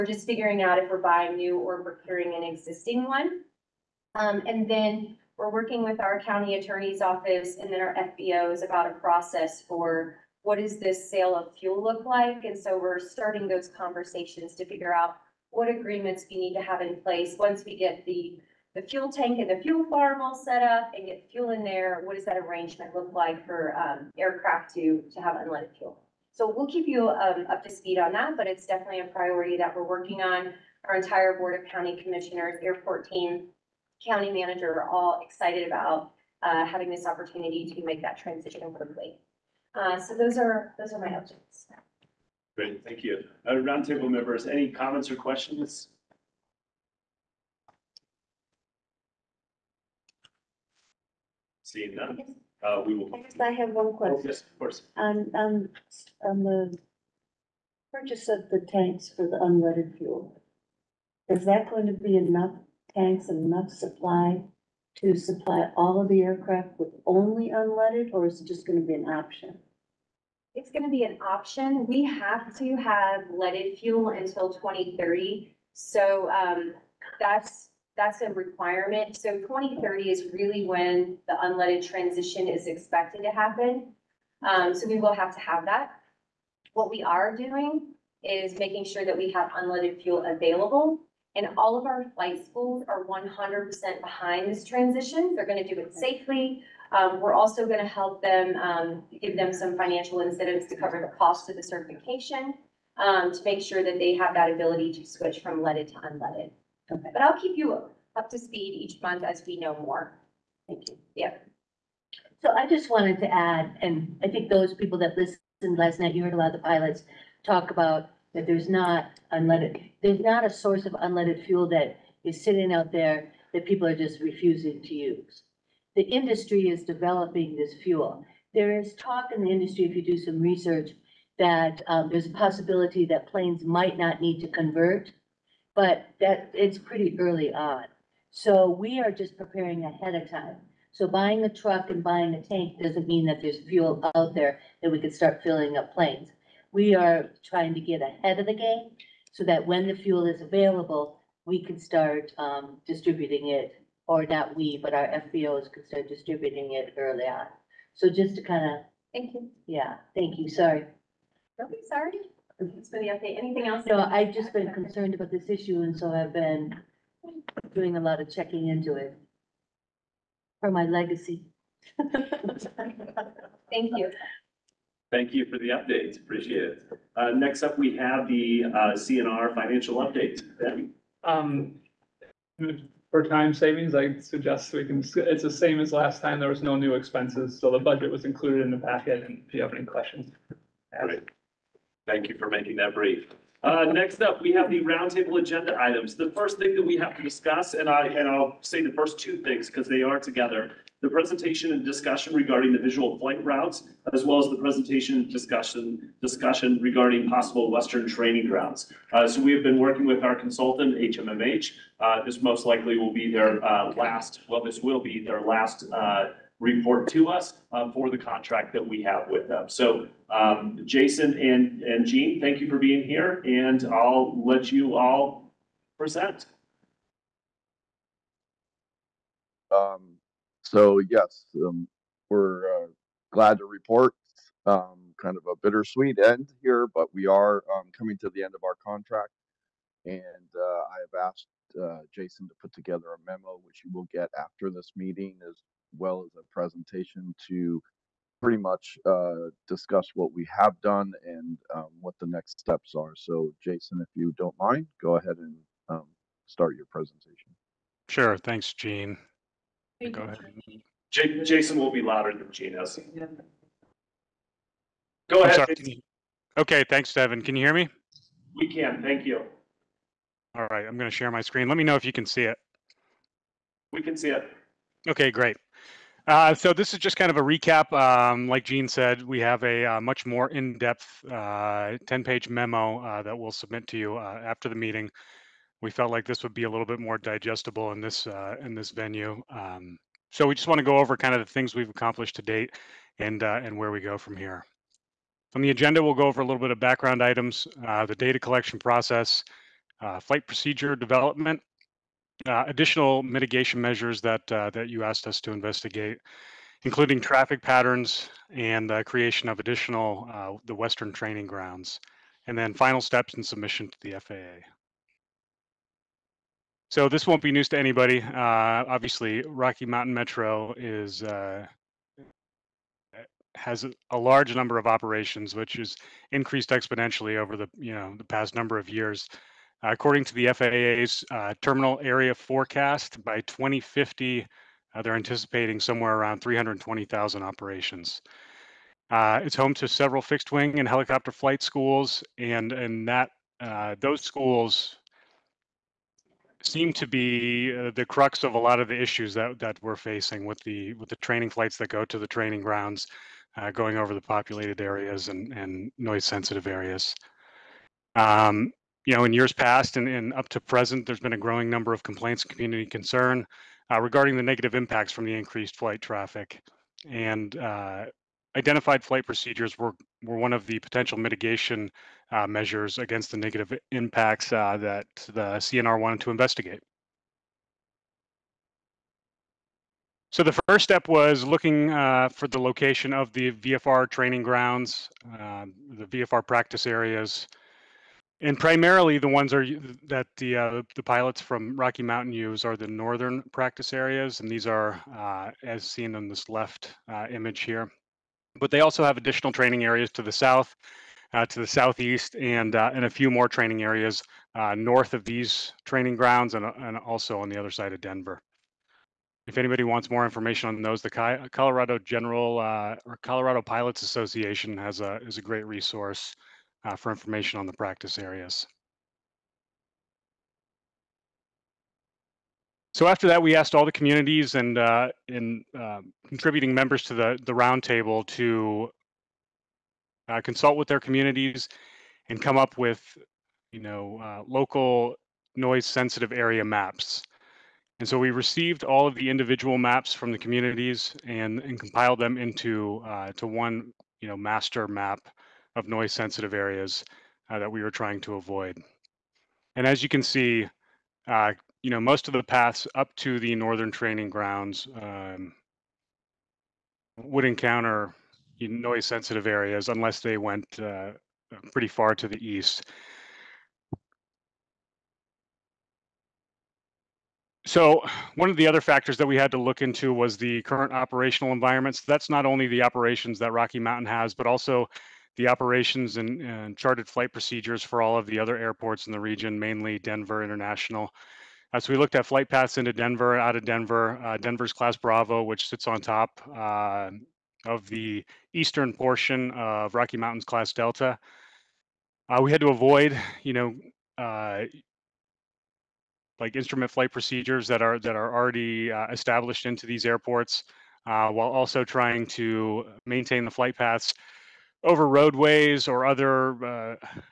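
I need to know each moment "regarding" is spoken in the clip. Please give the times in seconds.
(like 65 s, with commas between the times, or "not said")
202 s, 206 s, 363 s.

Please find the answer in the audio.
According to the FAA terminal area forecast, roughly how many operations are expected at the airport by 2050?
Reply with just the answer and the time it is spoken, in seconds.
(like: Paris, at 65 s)
320,000, at 336 s.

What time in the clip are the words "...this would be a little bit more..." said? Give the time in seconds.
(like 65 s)
286 s.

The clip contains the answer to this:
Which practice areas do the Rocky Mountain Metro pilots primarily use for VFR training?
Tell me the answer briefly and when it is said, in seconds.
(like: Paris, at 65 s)
Northern practice areas, at 392 s.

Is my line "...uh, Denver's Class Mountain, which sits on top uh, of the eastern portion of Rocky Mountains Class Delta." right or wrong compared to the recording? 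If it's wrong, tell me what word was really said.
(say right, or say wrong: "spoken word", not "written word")
wrong: "Bravo", not "Mountain".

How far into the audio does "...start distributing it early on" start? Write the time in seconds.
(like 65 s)
155 s.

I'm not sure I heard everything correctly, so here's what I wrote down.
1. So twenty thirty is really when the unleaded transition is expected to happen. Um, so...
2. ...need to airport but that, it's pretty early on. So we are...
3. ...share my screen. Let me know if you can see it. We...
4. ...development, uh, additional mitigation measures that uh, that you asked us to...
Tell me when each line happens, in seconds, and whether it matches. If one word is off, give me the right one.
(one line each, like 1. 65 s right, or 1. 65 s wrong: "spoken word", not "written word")
1. 79 s right
2. 134 s wrong: "convert", not "airport"
3. 271 s right
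4. 300 s right.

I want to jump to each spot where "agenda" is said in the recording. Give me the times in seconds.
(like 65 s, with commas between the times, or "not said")
195 s, 295 s.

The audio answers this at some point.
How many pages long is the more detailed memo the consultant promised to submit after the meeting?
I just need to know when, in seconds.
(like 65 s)
281 s.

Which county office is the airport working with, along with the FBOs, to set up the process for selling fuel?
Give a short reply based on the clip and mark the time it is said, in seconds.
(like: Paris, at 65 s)
County attorney's office, at 6 s.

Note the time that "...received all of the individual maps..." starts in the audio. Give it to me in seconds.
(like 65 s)
438 s.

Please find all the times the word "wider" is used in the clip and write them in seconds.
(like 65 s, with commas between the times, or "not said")
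not said.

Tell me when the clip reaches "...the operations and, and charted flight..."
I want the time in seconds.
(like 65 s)
475 s.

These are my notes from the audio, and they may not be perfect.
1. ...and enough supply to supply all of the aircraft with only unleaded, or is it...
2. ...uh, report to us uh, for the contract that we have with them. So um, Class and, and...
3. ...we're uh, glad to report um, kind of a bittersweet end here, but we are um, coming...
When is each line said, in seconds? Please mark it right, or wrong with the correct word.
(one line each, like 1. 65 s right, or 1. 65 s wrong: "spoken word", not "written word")
1. 63 s right
2. 215 s wrong: "Jason", not "Class"
3. 232 s right.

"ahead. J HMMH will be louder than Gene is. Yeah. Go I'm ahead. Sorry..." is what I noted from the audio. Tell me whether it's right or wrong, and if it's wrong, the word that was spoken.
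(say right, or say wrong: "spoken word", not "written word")
wrong: "Jason", not "HMMH".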